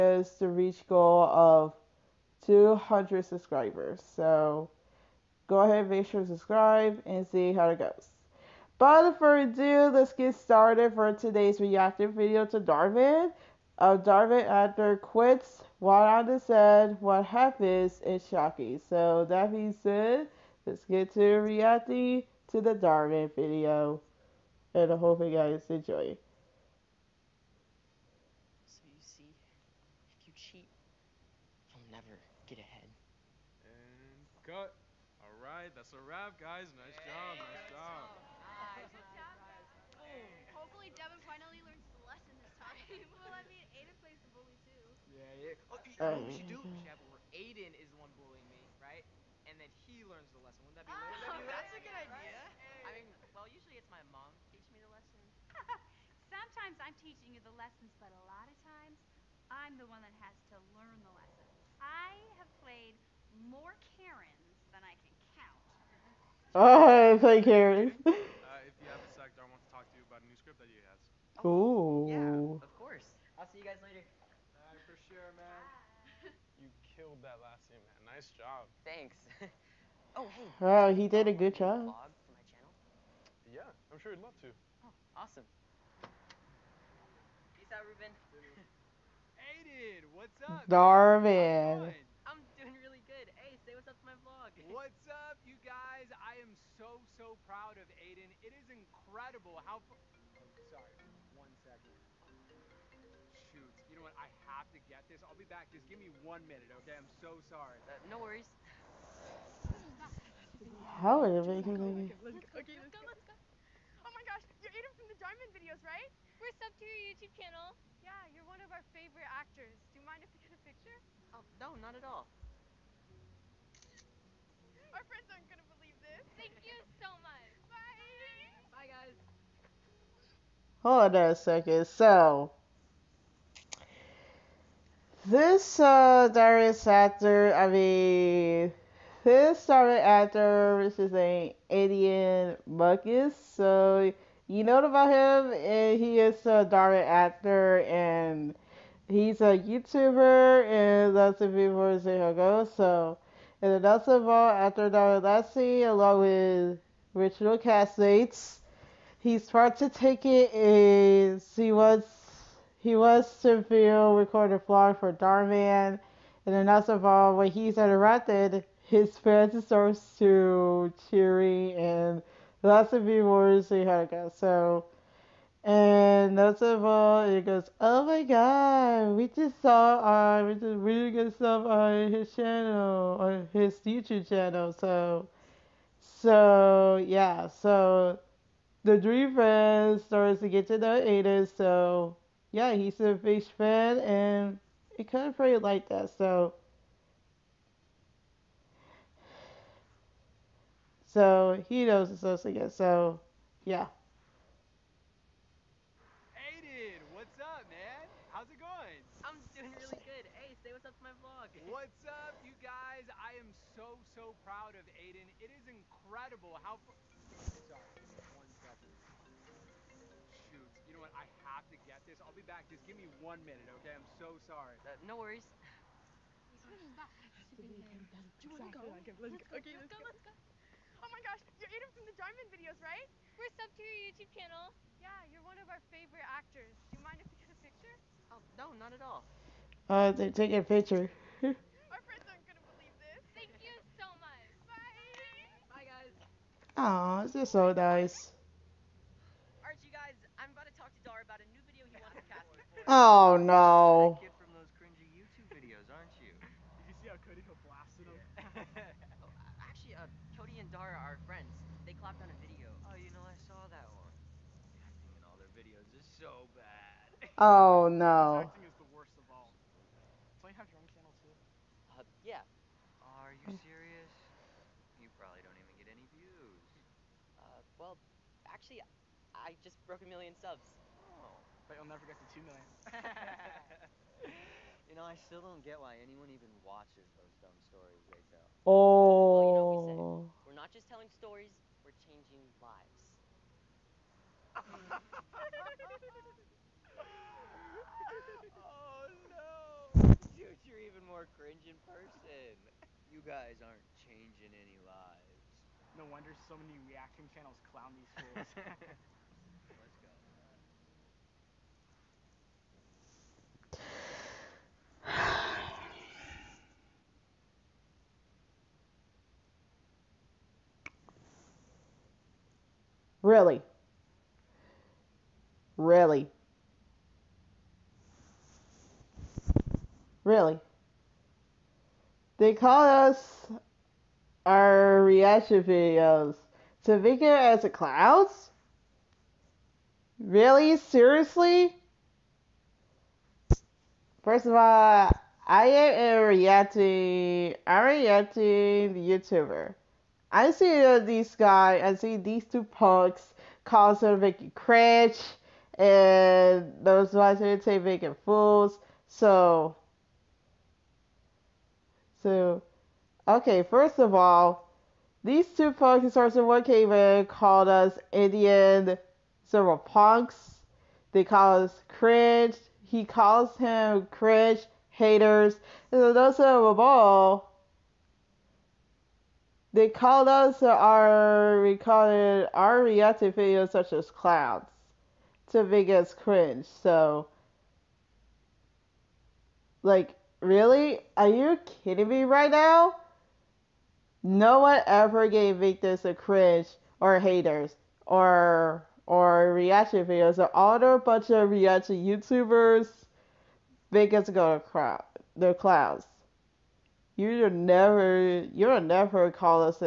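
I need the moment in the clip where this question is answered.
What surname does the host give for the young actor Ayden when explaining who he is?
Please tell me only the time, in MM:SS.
02:22.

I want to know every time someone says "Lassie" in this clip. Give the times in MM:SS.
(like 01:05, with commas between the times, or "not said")
02:35.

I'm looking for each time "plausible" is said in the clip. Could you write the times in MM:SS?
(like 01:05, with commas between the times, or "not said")
not said.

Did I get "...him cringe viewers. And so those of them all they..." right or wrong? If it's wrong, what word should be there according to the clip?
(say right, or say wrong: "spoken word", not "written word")
wrong: "haters", not "viewers".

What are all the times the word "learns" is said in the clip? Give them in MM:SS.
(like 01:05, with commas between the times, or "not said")
00:50, 01:00.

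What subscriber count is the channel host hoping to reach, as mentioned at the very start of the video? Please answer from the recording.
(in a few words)
200.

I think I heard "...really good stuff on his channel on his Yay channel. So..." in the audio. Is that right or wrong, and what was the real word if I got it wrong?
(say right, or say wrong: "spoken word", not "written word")
wrong: "YouTube", not "Yay".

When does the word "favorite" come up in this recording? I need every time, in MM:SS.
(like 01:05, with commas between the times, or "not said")
01:58, 03:55.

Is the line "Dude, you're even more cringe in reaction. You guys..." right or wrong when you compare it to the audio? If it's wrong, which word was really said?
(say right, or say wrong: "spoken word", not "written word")
wrong: "person", not "reaction".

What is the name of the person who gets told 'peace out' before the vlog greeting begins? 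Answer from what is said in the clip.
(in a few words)
Ruben.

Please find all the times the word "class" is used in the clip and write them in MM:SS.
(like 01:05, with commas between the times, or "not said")
not said.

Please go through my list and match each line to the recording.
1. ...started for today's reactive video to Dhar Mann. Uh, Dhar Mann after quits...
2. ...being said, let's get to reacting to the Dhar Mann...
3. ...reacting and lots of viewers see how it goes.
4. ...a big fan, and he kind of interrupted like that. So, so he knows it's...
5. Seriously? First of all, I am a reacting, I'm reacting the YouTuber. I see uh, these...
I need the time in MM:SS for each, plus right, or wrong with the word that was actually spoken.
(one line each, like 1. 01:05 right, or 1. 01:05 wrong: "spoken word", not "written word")
1. 00:10 right
2. 00:19 right
3. 02:51 wrong: "cheering", not "reacting"
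4. 03:13 wrong: "played", not "interrupted"
5. 05:40 right.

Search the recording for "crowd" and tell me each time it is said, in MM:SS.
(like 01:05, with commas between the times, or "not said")
06:44.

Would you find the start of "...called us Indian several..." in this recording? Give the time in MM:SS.
06:07.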